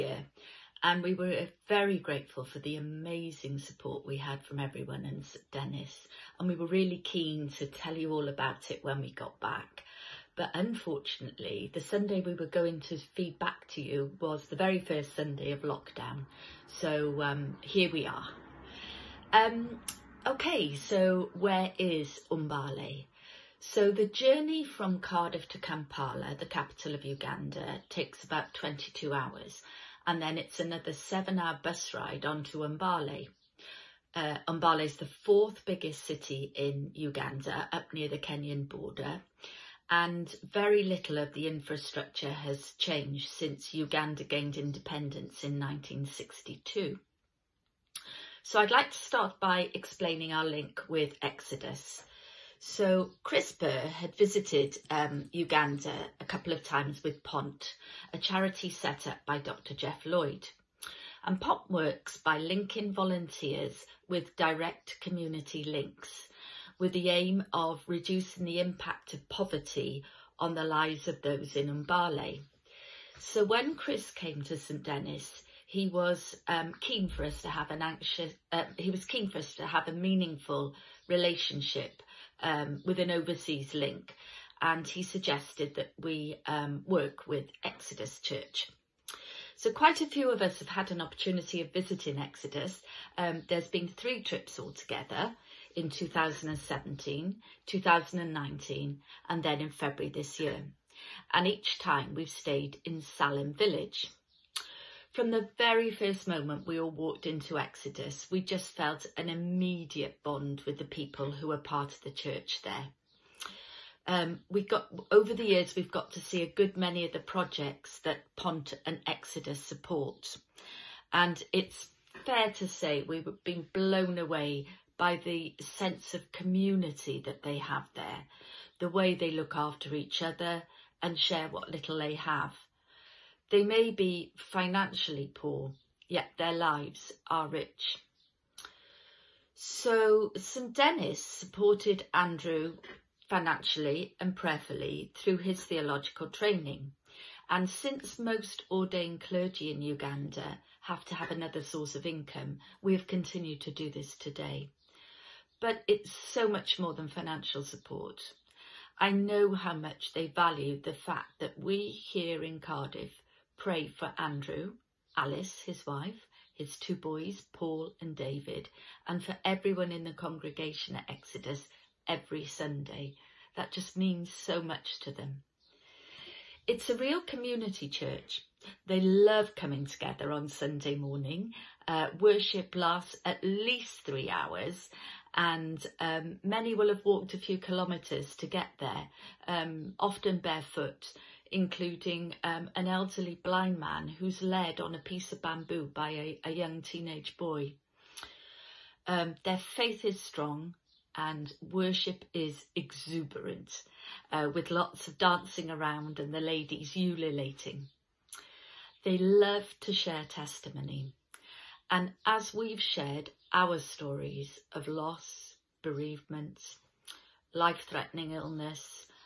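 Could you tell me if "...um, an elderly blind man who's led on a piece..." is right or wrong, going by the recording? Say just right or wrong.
right.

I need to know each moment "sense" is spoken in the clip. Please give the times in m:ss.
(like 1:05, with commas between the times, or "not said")
2:05.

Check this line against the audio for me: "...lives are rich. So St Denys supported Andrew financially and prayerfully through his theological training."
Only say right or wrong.
right.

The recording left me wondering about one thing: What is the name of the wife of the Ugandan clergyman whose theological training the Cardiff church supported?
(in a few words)
Alice.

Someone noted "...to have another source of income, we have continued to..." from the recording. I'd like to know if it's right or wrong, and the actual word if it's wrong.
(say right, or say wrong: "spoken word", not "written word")
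right.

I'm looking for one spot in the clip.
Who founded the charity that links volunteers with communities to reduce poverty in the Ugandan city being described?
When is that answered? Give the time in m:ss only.
0:59.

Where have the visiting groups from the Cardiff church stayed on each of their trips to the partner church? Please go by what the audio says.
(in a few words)
Salem Village.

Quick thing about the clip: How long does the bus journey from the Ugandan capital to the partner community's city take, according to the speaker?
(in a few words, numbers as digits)
7 hours.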